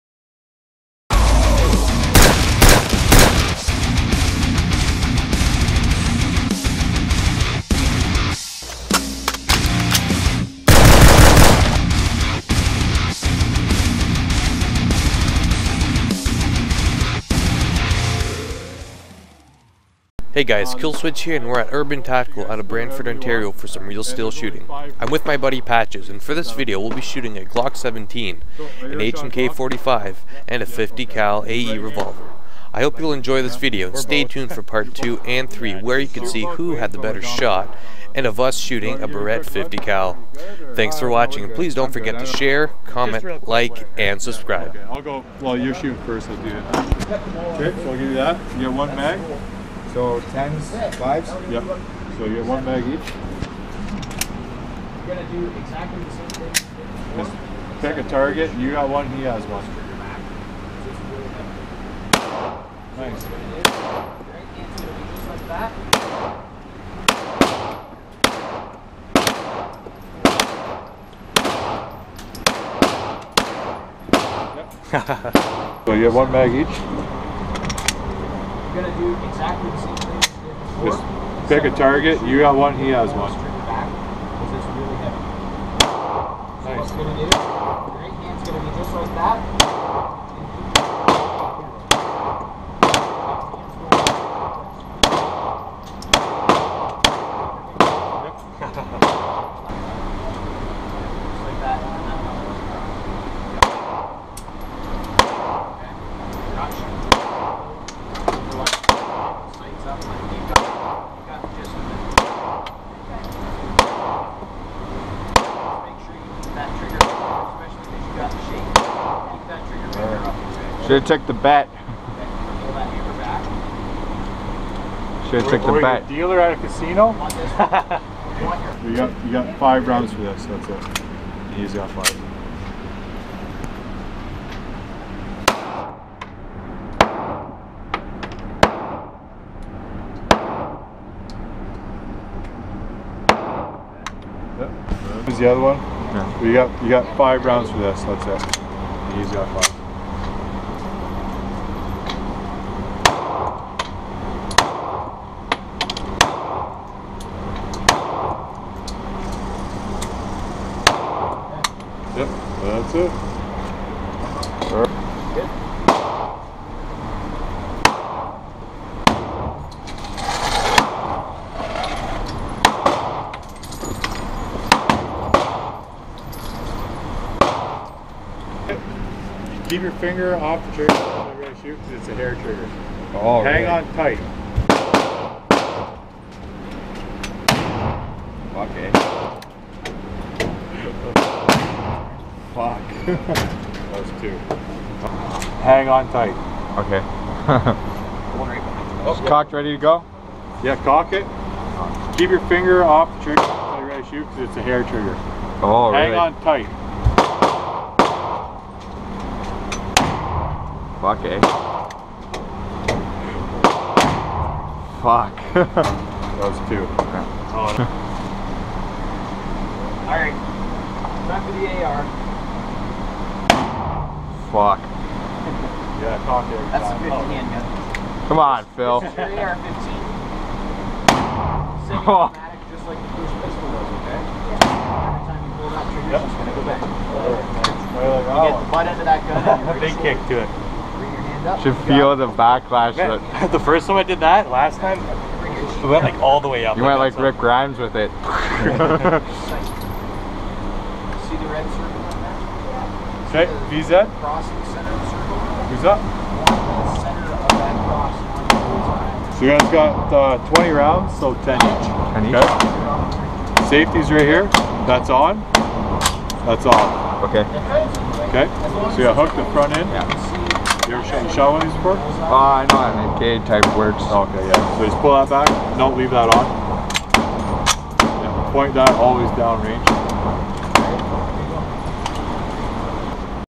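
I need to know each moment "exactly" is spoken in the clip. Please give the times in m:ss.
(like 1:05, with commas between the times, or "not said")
0:55, 1:19.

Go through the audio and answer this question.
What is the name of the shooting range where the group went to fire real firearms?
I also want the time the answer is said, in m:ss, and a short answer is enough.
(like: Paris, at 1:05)
Urban Tactical, at 0:21.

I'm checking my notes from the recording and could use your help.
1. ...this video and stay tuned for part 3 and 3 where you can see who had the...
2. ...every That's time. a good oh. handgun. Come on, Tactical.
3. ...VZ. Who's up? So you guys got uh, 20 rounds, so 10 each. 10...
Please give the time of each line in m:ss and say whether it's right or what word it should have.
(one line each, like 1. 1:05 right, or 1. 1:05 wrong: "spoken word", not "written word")
1. 0:33 wrong: "2", not "3"
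2. 3:46 wrong: "Phil", not "Tactical"
3. 4:13 right.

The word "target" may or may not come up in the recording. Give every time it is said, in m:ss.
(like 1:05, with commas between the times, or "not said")
0:58, 1:21.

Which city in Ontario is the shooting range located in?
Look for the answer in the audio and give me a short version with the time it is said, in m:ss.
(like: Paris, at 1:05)
Brantford, at 0:22.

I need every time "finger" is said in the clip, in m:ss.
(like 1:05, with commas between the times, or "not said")
2:59, 3:22.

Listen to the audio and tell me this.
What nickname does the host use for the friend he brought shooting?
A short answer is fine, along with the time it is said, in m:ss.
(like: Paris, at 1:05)
Patches, at 0:25.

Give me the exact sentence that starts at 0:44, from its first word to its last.
I'll go, well you're shooting first, I'll do it.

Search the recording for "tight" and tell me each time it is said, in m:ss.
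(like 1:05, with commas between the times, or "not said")
3:03, 3:16, 3:26.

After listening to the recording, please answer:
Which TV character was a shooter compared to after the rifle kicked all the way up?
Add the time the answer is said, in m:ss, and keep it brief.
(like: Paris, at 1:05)
Rick Grimes, at 4:07.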